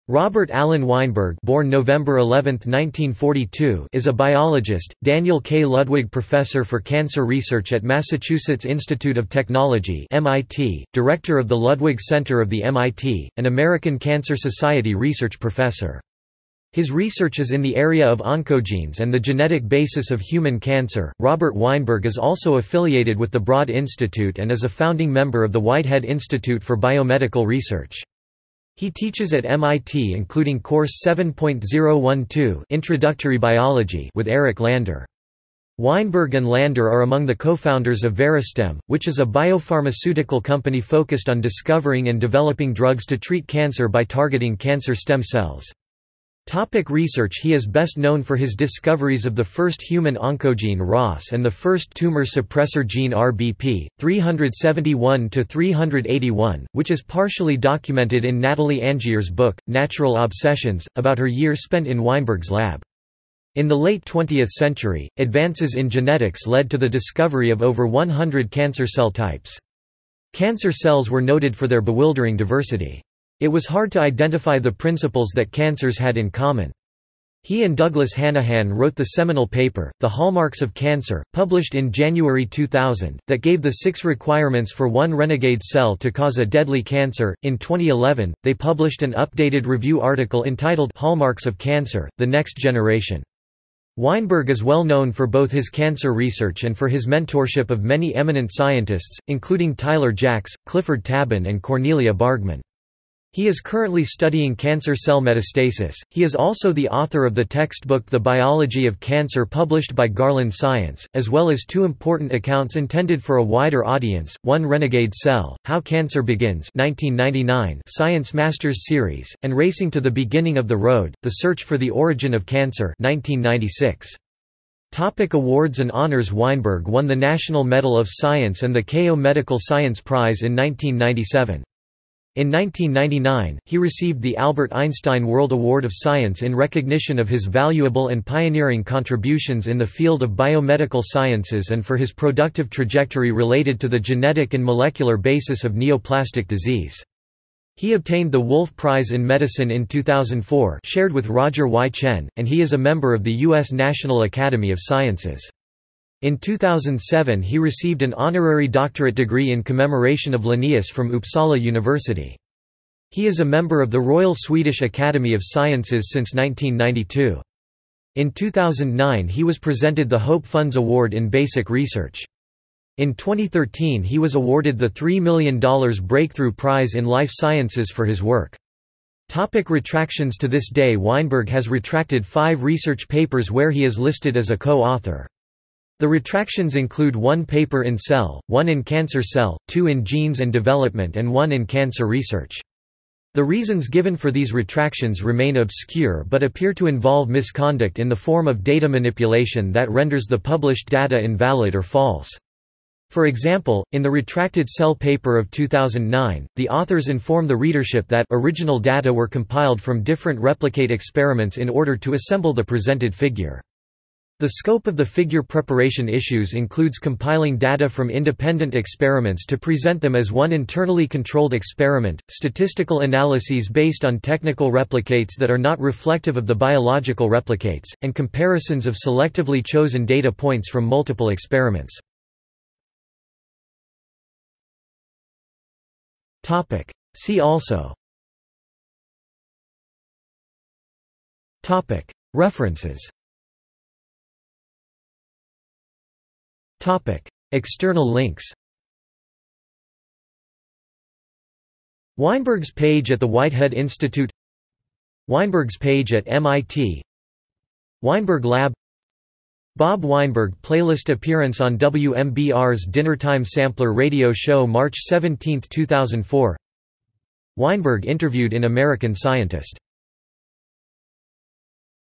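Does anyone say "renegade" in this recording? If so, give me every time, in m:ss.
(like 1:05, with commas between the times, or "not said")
1:25, 1:54.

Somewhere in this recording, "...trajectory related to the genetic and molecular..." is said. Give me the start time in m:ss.
2:22.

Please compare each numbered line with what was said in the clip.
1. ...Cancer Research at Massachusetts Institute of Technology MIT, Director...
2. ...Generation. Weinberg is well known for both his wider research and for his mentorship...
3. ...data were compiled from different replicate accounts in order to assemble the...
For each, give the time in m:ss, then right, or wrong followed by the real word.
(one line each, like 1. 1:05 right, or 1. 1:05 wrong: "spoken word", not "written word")
1. 0:06 right
2. 1:32 wrong: "cancer", not "wider"
3. 3:28 wrong: "experiments", not "accounts".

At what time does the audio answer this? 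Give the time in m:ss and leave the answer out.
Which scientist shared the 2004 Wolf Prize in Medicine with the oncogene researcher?
2:31.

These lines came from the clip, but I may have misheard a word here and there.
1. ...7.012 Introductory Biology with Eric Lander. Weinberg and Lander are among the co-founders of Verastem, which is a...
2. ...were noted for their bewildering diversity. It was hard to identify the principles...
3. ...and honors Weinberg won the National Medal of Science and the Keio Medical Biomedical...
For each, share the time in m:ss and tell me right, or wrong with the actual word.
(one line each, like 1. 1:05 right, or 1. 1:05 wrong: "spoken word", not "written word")
1. 0:31 right
2. 1:11 right
3. 2:05 wrong: "Science", not "Biomedical".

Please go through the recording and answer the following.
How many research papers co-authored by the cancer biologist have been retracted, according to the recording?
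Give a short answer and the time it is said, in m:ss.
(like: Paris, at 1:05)
5, at 3:02.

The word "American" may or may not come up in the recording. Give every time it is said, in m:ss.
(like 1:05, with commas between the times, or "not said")
0:13, 4:28.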